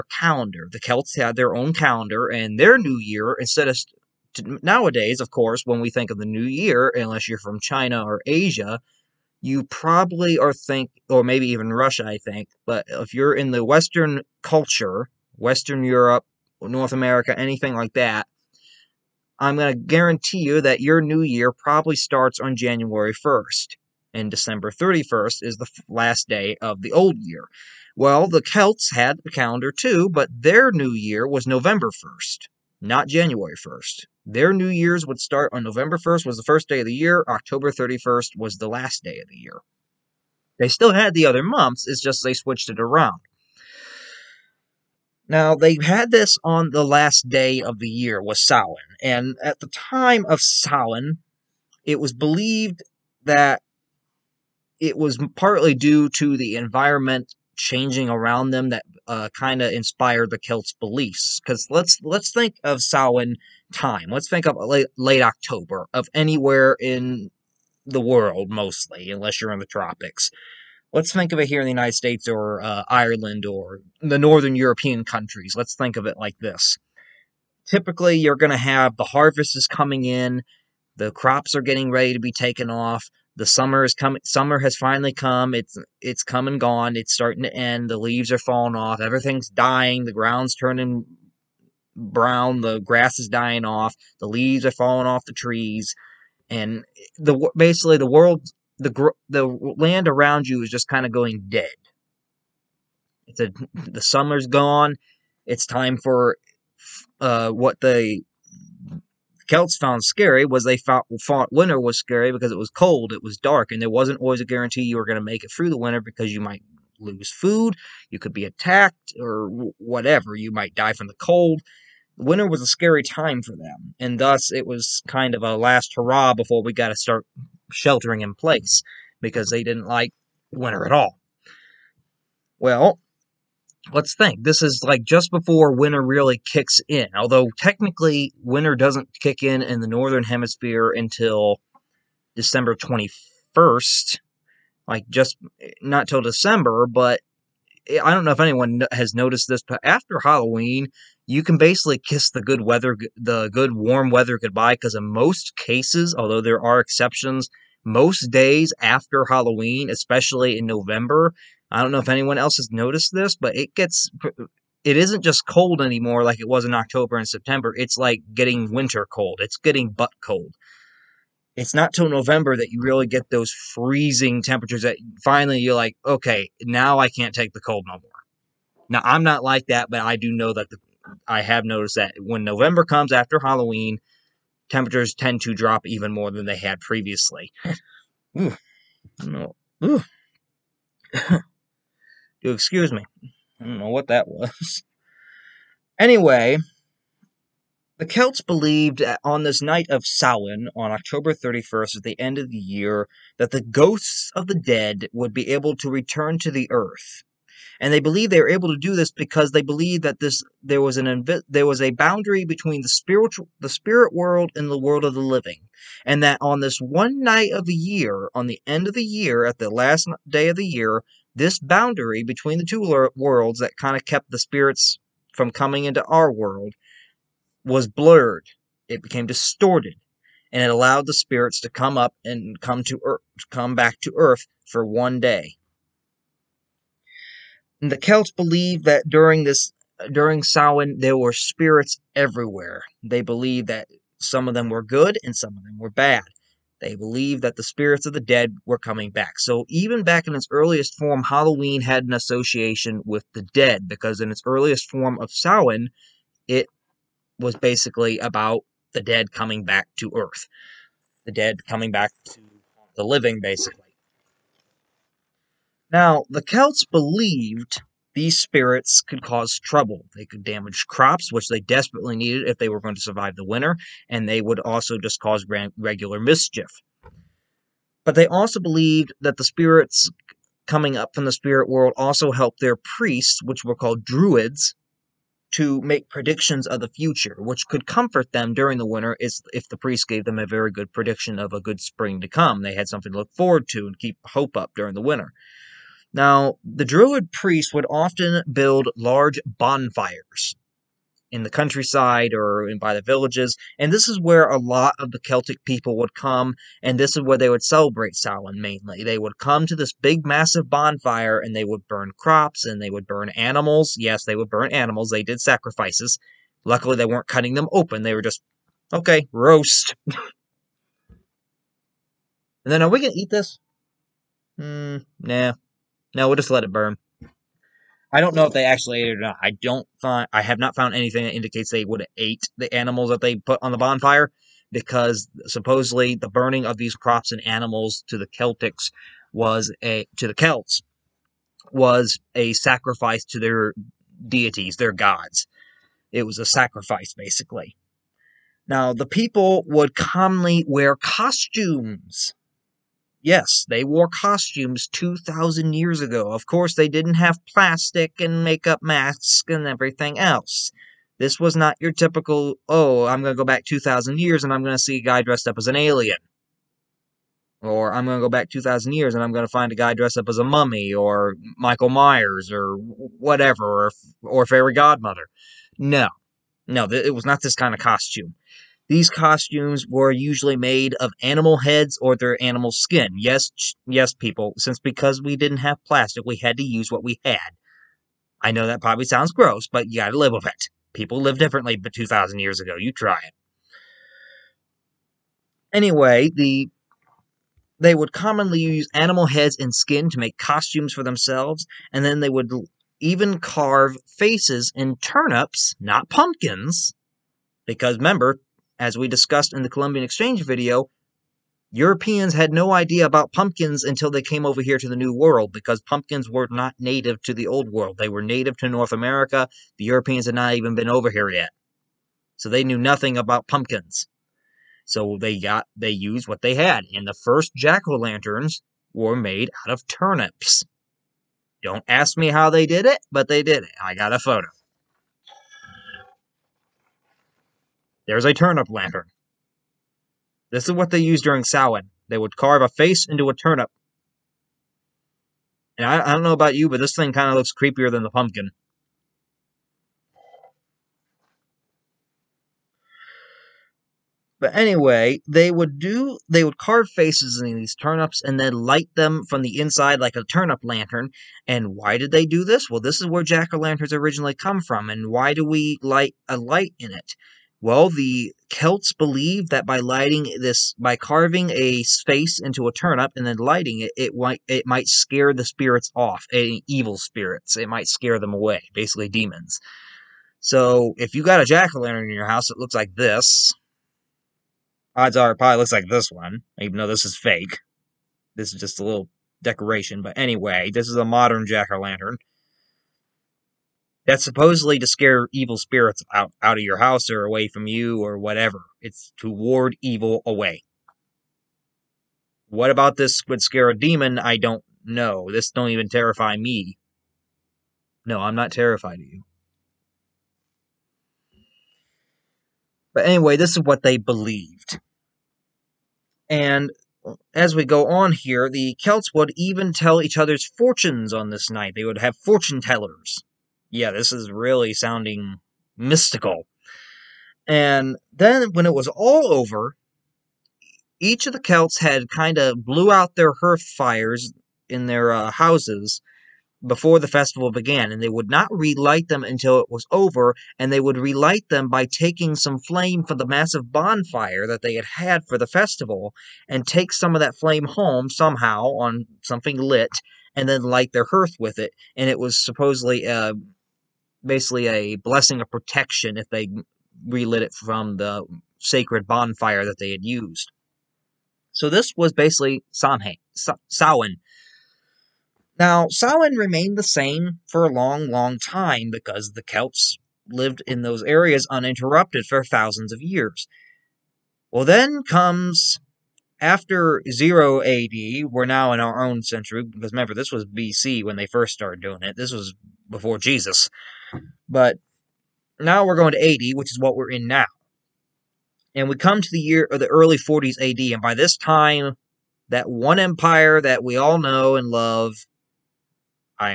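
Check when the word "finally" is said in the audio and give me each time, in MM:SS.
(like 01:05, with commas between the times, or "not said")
01:24, 02:55.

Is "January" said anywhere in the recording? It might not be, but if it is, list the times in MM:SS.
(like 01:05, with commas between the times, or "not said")
00:22, 00:33.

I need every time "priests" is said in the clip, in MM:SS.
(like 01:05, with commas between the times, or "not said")
04:42, 04:49, 04:57.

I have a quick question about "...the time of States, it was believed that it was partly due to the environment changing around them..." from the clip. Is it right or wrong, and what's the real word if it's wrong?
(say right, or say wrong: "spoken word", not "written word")
wrong: "Samhain", not "States".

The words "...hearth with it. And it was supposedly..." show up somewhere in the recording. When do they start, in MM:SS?
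09:11.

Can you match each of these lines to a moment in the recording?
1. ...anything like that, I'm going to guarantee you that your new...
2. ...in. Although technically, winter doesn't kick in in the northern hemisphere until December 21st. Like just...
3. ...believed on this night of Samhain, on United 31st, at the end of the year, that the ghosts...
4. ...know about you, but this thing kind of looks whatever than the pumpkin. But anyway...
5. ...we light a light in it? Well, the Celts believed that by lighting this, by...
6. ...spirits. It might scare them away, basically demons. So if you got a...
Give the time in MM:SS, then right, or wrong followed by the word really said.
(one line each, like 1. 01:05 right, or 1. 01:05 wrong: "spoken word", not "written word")
1. 00:17 right
2. 02:16 right
3. 03:18 wrong: "October", not "United"
4. 07:26 wrong: "creepier", not "whatever"
5. 07:45 right
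6. 07:56 right.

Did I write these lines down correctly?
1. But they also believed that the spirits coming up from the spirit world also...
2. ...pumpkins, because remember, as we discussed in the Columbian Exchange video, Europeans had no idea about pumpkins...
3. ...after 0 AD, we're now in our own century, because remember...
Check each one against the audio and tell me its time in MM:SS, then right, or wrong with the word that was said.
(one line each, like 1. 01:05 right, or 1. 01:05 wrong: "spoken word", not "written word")
1. 04:38 right
2. 06:46 right
3. 09:36 right.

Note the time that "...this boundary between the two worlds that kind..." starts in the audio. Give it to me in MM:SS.
03:41.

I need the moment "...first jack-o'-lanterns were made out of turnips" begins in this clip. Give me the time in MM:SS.
07:07.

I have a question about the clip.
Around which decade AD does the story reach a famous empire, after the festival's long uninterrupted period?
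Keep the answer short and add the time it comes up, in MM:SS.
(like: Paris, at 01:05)
early 40s AD, at 09:49.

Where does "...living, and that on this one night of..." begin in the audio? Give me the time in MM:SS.
03:35.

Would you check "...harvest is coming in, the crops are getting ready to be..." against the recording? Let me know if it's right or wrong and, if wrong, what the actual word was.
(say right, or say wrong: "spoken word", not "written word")
right.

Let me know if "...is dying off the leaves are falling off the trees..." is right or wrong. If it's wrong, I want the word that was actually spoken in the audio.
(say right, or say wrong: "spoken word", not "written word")
right.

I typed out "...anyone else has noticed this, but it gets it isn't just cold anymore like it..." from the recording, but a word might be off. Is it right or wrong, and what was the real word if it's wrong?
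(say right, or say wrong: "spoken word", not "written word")
right.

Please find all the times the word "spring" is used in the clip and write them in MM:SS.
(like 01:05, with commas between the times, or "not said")
04:51.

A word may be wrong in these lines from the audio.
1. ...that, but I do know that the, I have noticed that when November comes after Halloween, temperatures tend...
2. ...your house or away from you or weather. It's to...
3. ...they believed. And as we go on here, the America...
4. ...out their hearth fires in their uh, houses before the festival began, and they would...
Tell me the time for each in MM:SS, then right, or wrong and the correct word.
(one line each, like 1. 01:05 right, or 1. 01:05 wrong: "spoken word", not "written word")
1. 02:59 right
2. 08:16 wrong: "whatever", not "weather"
3. 08:33 wrong: "Celts", not "America"
4. 08:52 right.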